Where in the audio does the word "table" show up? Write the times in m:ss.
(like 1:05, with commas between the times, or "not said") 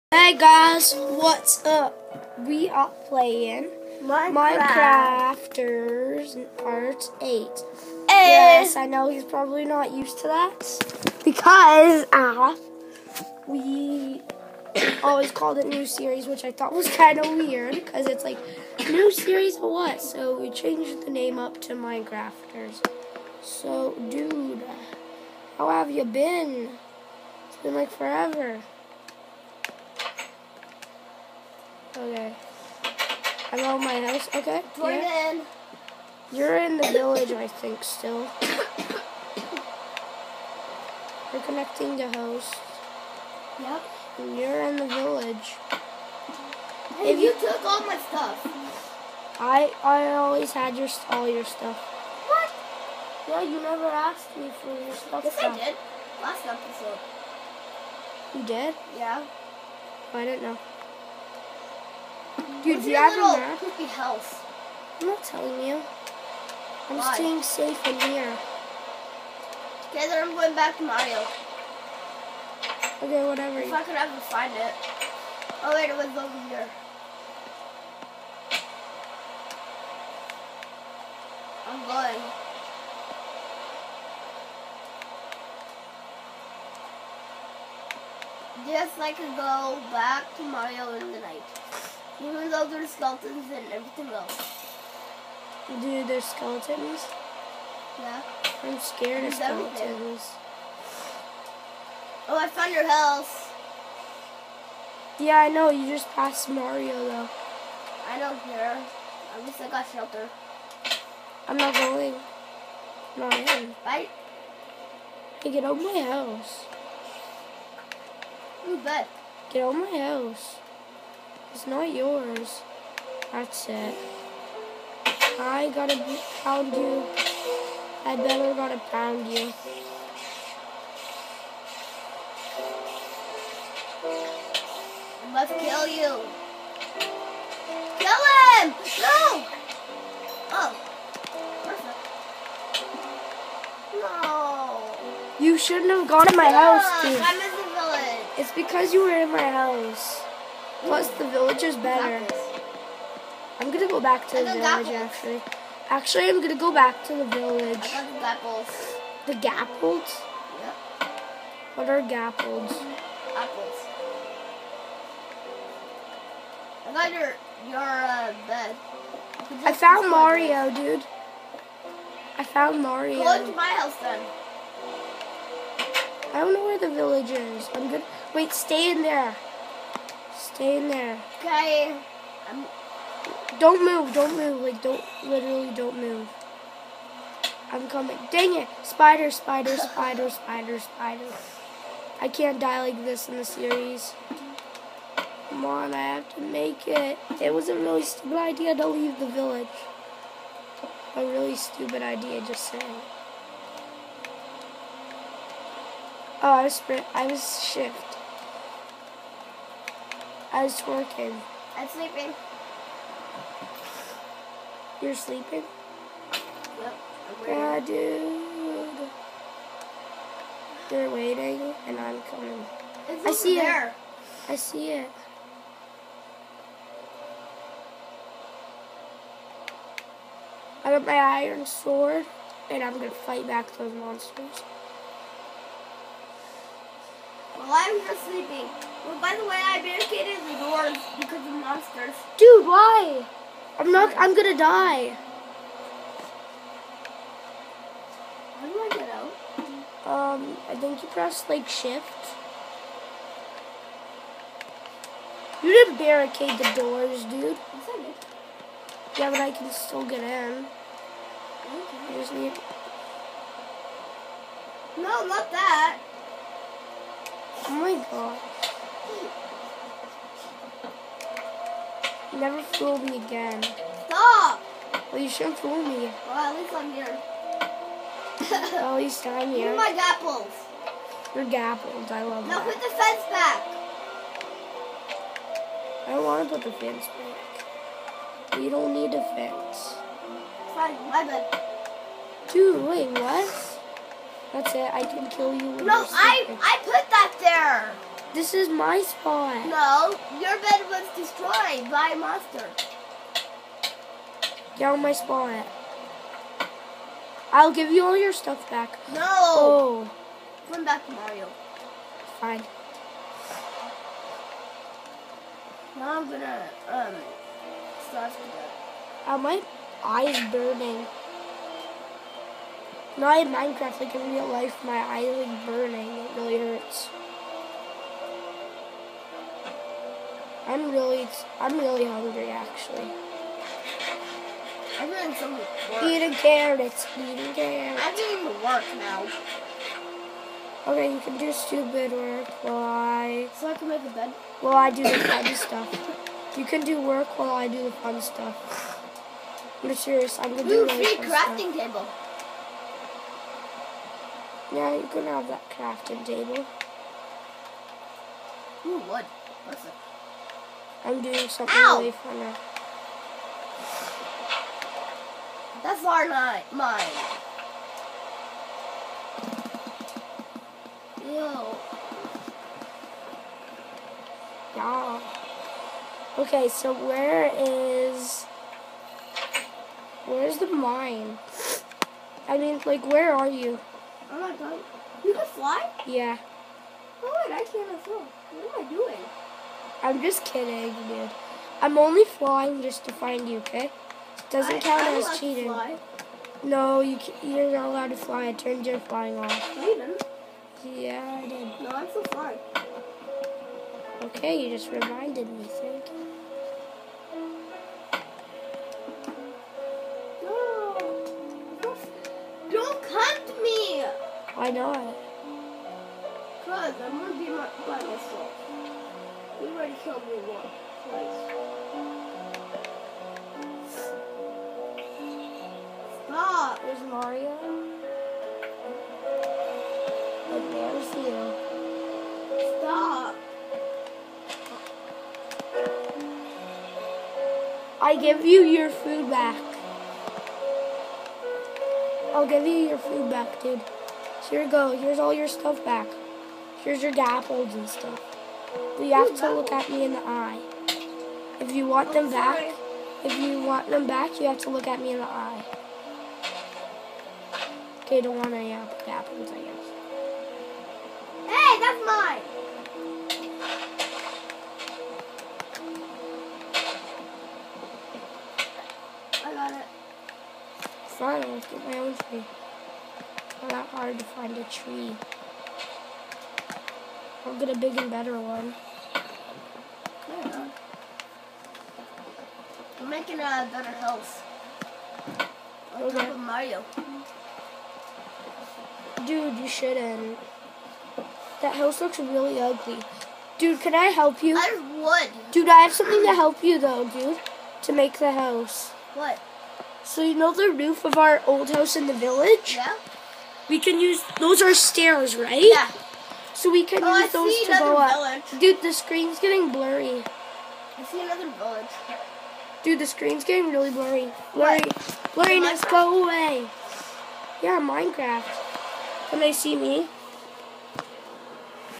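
5:51, 5:56.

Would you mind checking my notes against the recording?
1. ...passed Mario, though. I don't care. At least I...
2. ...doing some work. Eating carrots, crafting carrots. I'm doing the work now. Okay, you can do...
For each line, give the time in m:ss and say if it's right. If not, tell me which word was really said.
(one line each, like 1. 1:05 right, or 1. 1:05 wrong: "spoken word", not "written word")
1. 1:46 right
2. 5:35 wrong: "eating", not "crafting".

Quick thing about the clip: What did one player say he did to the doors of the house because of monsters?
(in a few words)
barricaded.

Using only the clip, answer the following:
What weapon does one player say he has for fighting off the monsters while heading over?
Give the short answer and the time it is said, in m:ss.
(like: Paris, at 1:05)
iron sword, at 3:50.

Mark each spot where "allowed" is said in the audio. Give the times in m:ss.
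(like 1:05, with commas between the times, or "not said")
6:37.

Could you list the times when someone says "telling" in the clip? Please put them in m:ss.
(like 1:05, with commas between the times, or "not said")
1:05.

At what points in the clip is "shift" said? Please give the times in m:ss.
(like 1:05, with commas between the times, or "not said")
3:27, 4:11.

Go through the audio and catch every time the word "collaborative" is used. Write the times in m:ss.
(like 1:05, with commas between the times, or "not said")
not said.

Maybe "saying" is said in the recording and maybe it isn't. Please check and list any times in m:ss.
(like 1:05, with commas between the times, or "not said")
3:22.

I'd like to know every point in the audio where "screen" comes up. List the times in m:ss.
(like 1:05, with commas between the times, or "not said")
8:28, 8:33.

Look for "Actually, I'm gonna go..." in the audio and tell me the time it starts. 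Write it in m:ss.
2:35.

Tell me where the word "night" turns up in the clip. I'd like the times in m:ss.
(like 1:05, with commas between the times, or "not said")
1:31.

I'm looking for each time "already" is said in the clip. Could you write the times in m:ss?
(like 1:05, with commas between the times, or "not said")
6:59.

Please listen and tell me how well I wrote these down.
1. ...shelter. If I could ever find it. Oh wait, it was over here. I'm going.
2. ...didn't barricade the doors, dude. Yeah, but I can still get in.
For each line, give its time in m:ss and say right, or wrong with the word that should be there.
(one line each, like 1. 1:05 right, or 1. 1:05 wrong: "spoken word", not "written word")
1. 1:13 wrong: "whatever", not "shelter"
2. 4:15 right.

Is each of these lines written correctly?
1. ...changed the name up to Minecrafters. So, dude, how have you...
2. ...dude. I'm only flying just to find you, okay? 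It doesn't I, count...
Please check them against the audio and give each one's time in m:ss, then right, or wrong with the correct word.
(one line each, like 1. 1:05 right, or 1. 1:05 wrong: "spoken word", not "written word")
1. 0:20 right
2. 6:31 right.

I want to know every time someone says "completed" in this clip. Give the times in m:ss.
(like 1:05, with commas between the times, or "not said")
not said.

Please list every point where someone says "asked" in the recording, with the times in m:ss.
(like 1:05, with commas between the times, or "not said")
0:53.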